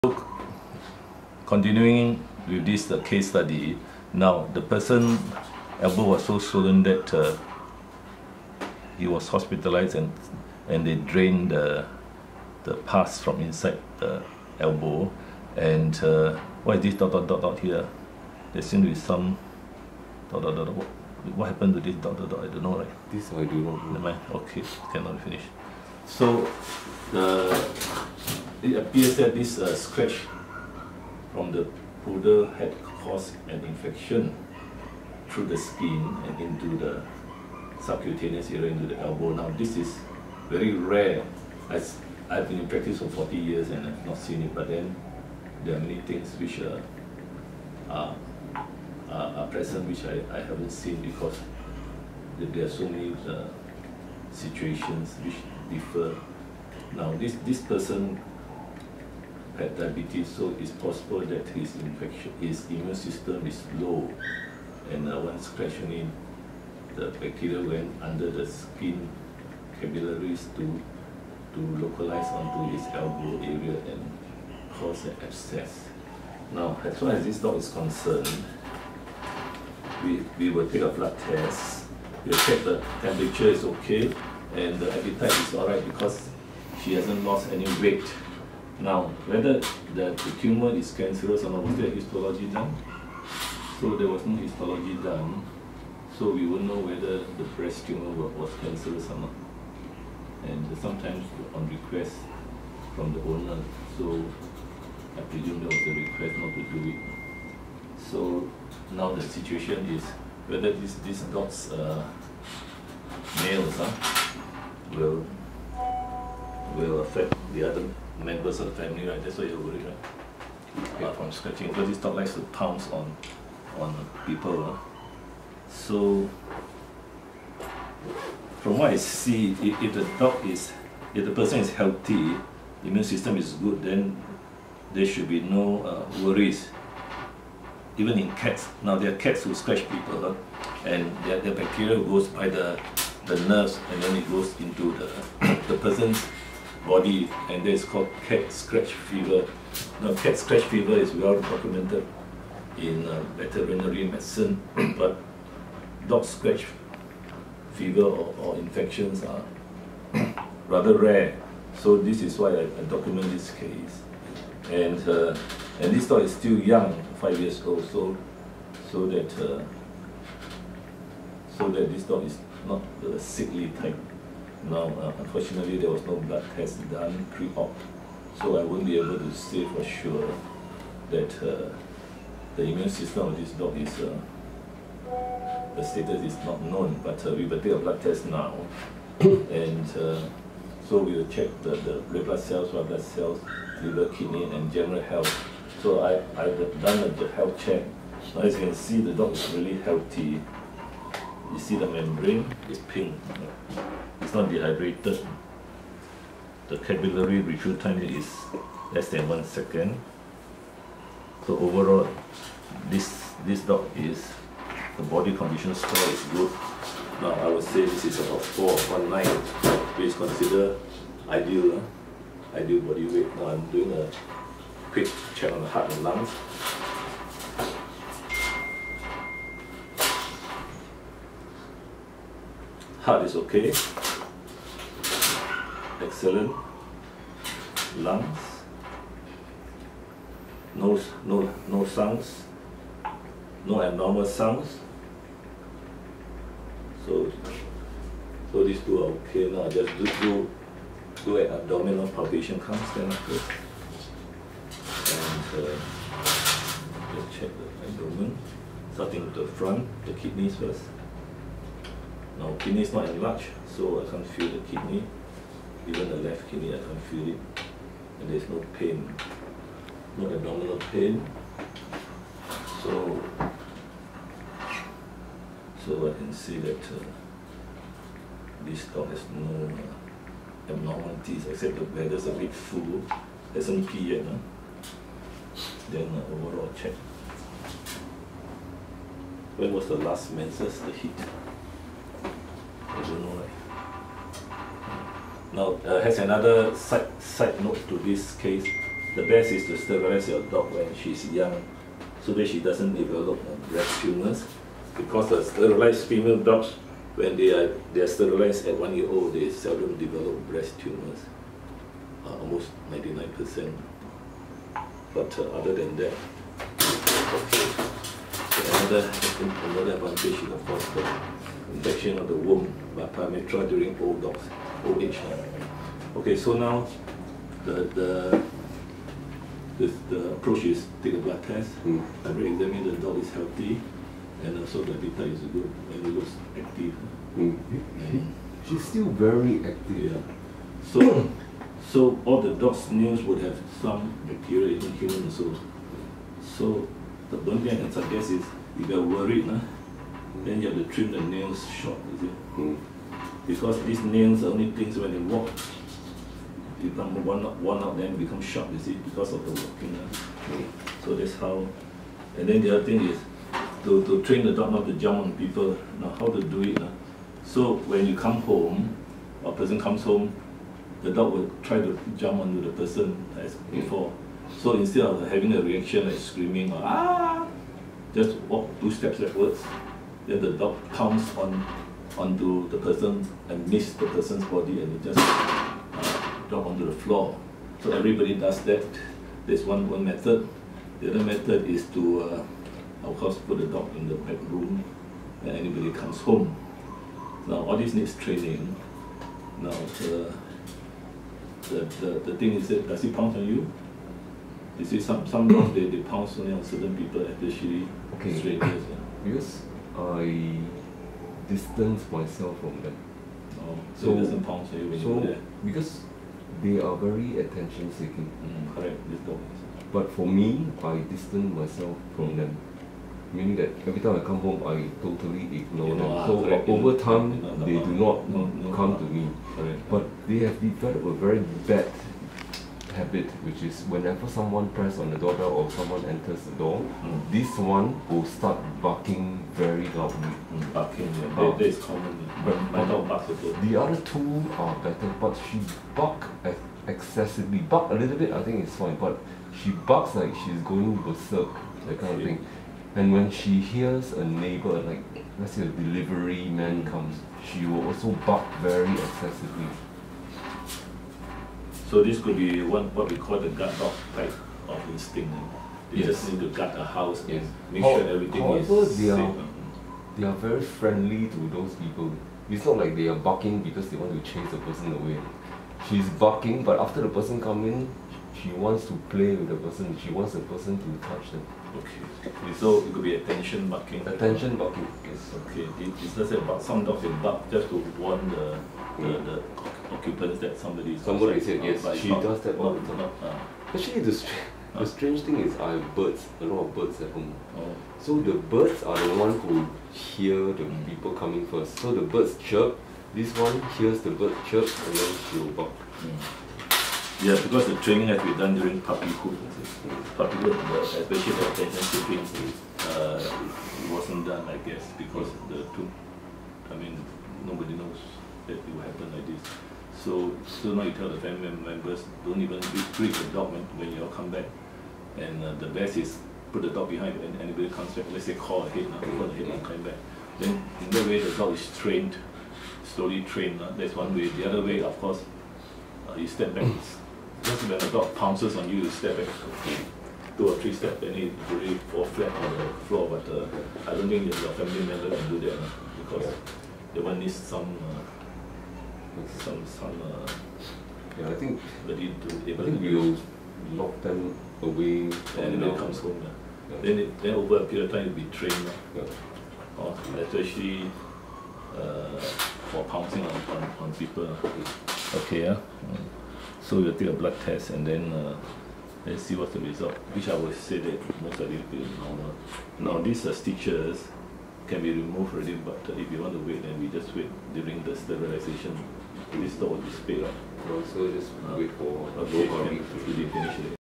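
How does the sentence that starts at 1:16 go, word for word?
Now, as far as this dog is concerned, we, we will take a blood test.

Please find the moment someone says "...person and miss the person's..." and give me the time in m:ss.
6:22.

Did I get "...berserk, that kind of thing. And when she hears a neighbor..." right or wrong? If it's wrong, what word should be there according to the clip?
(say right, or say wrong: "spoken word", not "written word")
right.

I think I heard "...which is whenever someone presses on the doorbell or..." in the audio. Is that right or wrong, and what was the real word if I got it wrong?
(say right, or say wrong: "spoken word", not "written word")
right.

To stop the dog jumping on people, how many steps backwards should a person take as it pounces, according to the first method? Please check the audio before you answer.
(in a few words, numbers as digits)
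2.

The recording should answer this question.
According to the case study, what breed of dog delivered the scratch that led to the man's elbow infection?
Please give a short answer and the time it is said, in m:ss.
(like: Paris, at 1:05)
Poodle, at 0:32.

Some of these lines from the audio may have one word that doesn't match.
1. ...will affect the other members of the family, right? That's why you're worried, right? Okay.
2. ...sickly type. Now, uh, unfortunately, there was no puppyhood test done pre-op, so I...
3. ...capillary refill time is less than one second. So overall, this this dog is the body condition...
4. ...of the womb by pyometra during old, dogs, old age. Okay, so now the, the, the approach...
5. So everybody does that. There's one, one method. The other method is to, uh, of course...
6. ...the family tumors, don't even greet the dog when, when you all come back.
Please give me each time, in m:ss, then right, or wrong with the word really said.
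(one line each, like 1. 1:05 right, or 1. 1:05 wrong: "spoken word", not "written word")
1. 1:56 right
2. 2:53 wrong: "blood", not "puppyhood"
3. 3:26 right
4. 5:22 right
5. 6:27 right
6. 8:41 wrong: "members", not "tumors".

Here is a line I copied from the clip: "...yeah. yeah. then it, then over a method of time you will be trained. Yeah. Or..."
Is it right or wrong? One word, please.
wrong.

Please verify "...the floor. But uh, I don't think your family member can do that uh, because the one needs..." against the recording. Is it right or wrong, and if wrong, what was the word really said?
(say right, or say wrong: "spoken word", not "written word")
right.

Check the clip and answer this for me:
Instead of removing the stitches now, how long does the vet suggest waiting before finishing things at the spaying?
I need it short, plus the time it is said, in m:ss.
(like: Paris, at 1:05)
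A week, at 9:42.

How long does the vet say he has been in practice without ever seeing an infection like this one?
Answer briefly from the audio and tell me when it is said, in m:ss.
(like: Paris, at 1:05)
40 years, at 0:43.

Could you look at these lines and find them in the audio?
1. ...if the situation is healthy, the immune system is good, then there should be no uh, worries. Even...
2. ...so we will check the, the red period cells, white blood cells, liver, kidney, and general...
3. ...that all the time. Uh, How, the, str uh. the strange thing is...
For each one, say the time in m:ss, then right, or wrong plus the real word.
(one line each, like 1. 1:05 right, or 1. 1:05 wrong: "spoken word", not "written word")
1. 2:11 wrong: "person", not "situation"
2. 3:10 wrong: "blood", not "period"
3. 8:12 wrong: "Actually", not "How".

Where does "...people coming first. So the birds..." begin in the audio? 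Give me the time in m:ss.
8:20.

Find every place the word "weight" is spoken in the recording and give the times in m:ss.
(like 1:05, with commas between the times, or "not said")
1:27, 3:43.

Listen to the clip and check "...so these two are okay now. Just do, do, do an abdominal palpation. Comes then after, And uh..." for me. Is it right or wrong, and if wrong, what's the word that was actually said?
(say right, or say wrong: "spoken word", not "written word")
right.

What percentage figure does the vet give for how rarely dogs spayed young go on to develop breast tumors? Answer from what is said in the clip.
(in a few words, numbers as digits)
99%.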